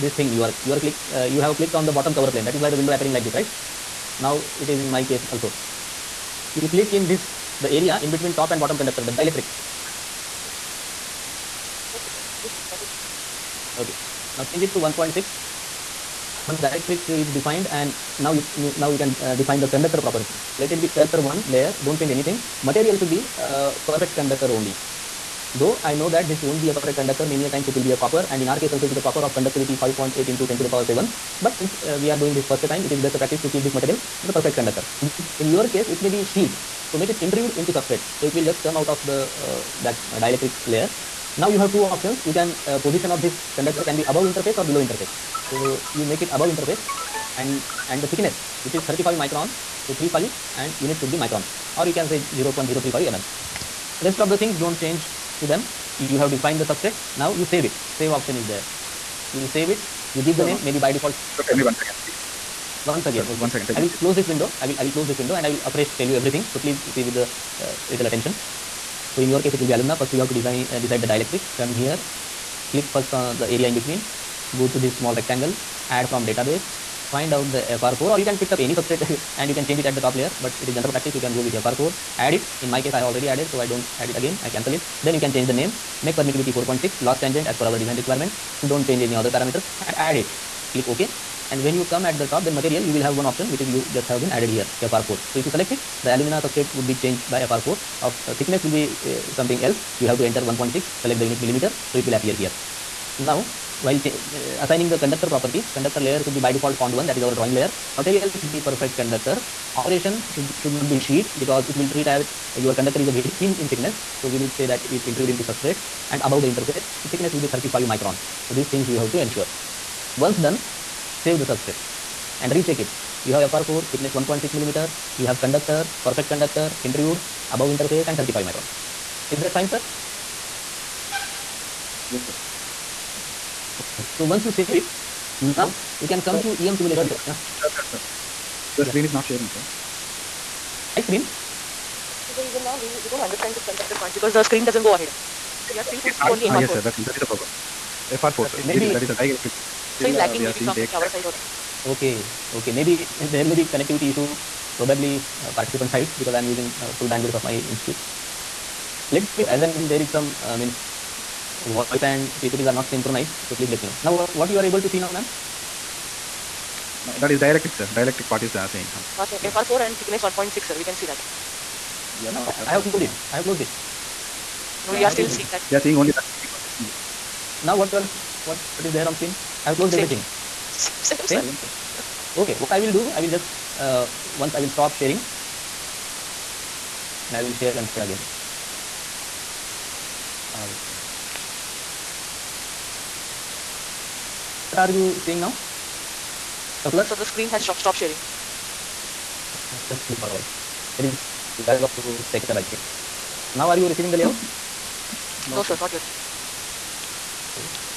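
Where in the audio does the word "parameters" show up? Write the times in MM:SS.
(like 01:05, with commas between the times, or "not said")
01:29.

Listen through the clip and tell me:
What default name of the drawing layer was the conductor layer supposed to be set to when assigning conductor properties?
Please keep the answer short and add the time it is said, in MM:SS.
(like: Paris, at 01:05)
cond1, at 01:46.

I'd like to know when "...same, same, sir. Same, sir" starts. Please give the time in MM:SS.
03:01.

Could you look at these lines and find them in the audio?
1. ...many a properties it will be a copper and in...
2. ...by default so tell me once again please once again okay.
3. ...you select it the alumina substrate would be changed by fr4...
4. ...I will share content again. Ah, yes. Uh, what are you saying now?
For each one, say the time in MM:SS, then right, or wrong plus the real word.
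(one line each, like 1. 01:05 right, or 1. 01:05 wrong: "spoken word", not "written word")
1. 00:27 wrong: "times", not "properties"
2. 01:00 right
3. 01:35 right
4. 03:07 right.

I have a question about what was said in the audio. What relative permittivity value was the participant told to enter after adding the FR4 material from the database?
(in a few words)
4.6.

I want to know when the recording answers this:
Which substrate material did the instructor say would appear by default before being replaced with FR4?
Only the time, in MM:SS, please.
01:09.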